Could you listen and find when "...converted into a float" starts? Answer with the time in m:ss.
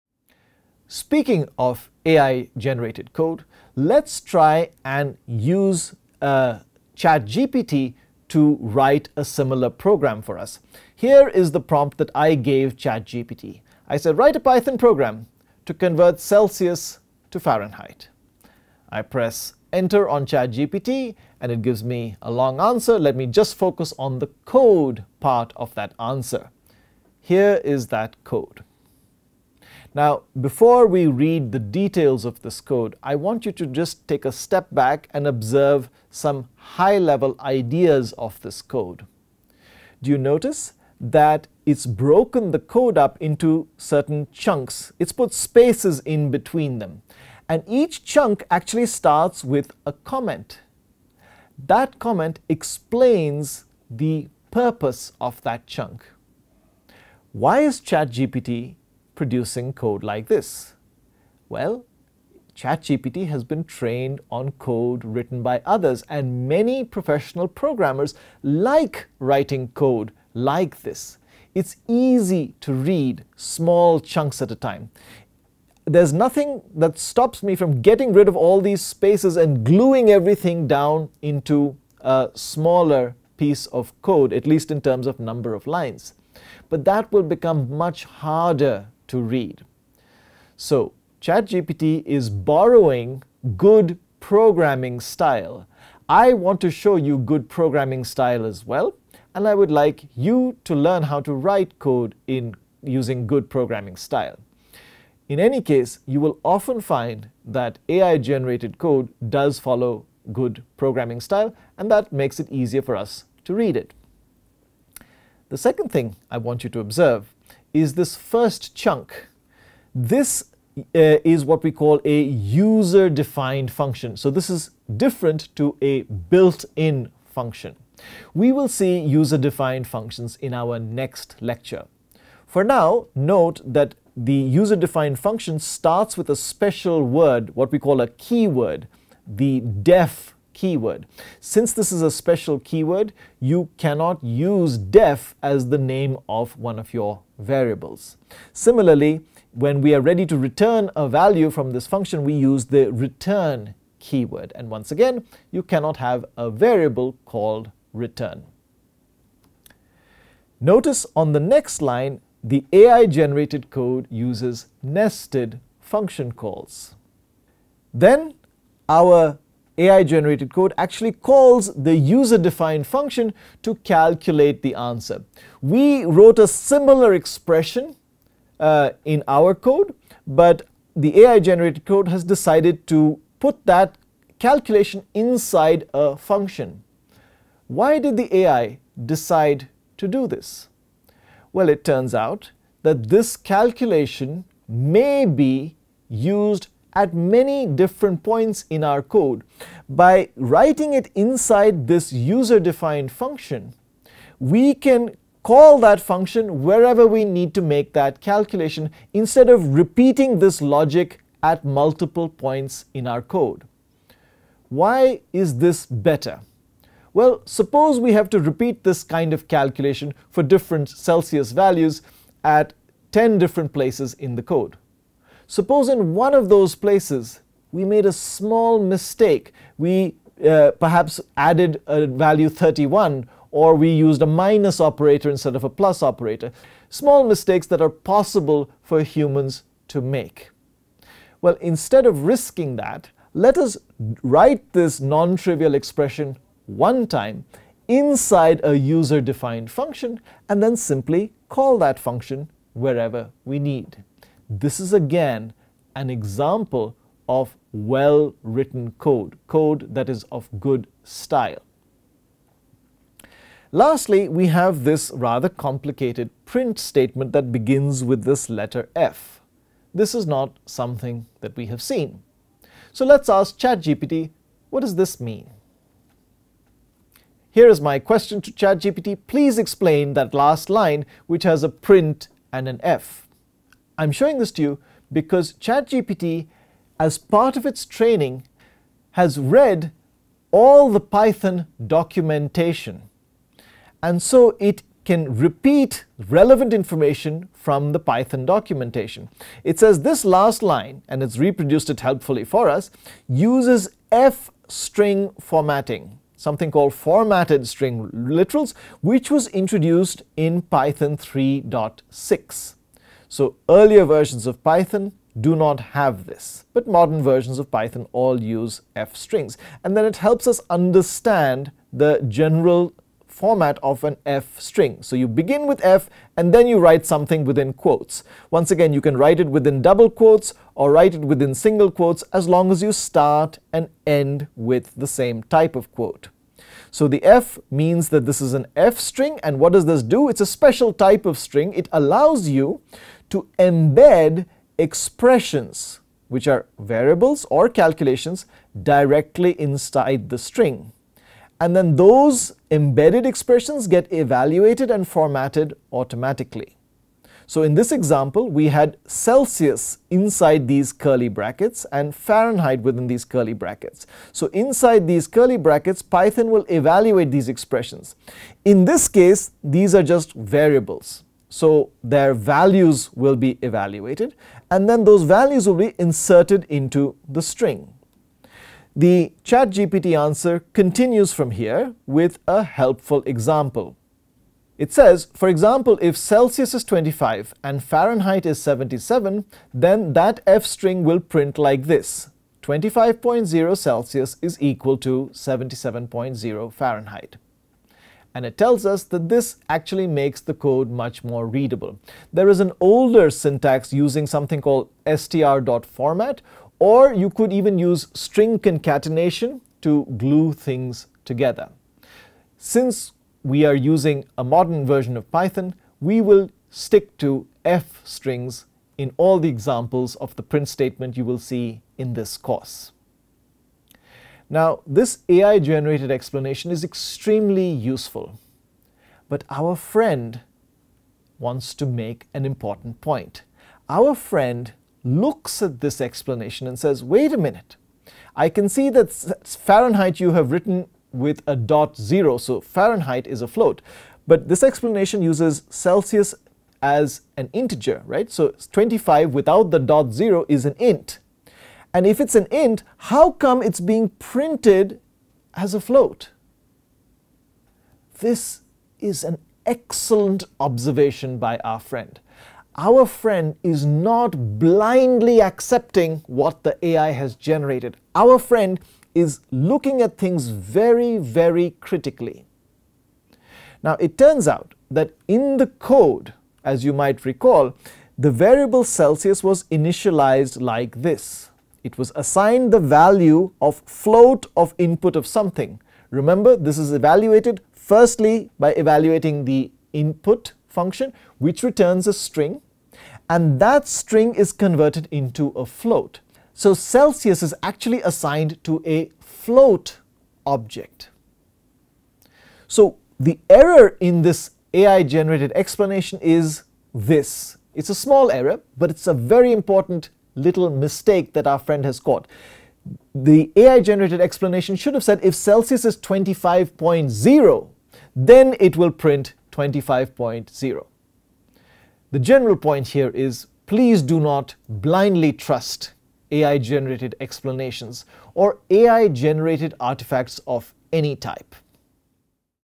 8:14.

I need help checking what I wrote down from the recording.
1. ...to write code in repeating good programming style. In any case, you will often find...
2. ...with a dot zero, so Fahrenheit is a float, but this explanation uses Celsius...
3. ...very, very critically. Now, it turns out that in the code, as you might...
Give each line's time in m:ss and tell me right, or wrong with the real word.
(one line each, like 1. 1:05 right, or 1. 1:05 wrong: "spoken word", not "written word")
1. 1:41 wrong: "using", not "repeating"
2. 7:21 right
3. 7:50 right.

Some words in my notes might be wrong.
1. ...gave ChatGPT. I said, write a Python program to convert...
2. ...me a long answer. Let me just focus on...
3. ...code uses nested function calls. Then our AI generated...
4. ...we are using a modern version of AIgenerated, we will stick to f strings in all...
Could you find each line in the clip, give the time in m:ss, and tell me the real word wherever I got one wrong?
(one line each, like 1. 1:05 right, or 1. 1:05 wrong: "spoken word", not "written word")
1. 0:12 right
2. 0:21 right
3. 2:43 right
4. 6:53 wrong: "Python", not "AIgenerated".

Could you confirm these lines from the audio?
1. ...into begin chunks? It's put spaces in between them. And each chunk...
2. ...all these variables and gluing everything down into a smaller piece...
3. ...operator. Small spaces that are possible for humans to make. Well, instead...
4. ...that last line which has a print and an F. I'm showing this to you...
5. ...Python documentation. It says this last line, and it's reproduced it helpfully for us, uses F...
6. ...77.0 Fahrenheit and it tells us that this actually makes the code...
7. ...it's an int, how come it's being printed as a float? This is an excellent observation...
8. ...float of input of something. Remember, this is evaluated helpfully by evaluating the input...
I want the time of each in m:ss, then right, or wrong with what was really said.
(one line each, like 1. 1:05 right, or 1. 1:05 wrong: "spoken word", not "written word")
1. 0:43 wrong: "certain", not "begin"
2. 1:18 wrong: "spaces", not "variables"
3. 3:56 wrong: "mistakes", not "spaces"
4. 4:40 right
5. 4:57 right
6. 6:35 right
7. 7:32 right
8. 8:03 wrong: "firstly", not "helpfully".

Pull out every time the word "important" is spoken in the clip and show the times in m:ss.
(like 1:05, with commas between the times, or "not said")
7:12, 8:29.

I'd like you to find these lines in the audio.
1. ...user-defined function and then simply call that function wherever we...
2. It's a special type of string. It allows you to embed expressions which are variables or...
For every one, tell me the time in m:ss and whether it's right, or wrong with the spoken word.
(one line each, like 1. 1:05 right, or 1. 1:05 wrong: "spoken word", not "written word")
1. 4:08 right
2. 5:40 right.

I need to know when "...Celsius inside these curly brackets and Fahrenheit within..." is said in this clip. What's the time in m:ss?
5:59.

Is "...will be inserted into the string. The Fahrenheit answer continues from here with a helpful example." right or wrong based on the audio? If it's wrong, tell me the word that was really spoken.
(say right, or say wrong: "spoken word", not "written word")
wrong: "ChatGPT", not "Fahrenheit".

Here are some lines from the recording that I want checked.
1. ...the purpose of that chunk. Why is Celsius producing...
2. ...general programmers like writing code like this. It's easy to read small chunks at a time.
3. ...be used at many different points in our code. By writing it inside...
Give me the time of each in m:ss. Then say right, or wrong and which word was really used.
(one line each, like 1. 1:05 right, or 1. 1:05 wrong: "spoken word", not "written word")
1. 0:53 wrong: "ChatGPT", not "Celsius"
2. 1:06 wrong: "professional", not "general"
3. 3:15 right.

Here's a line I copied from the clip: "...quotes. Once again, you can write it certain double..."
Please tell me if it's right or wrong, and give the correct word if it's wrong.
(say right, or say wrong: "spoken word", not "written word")
wrong: "within", not "certain".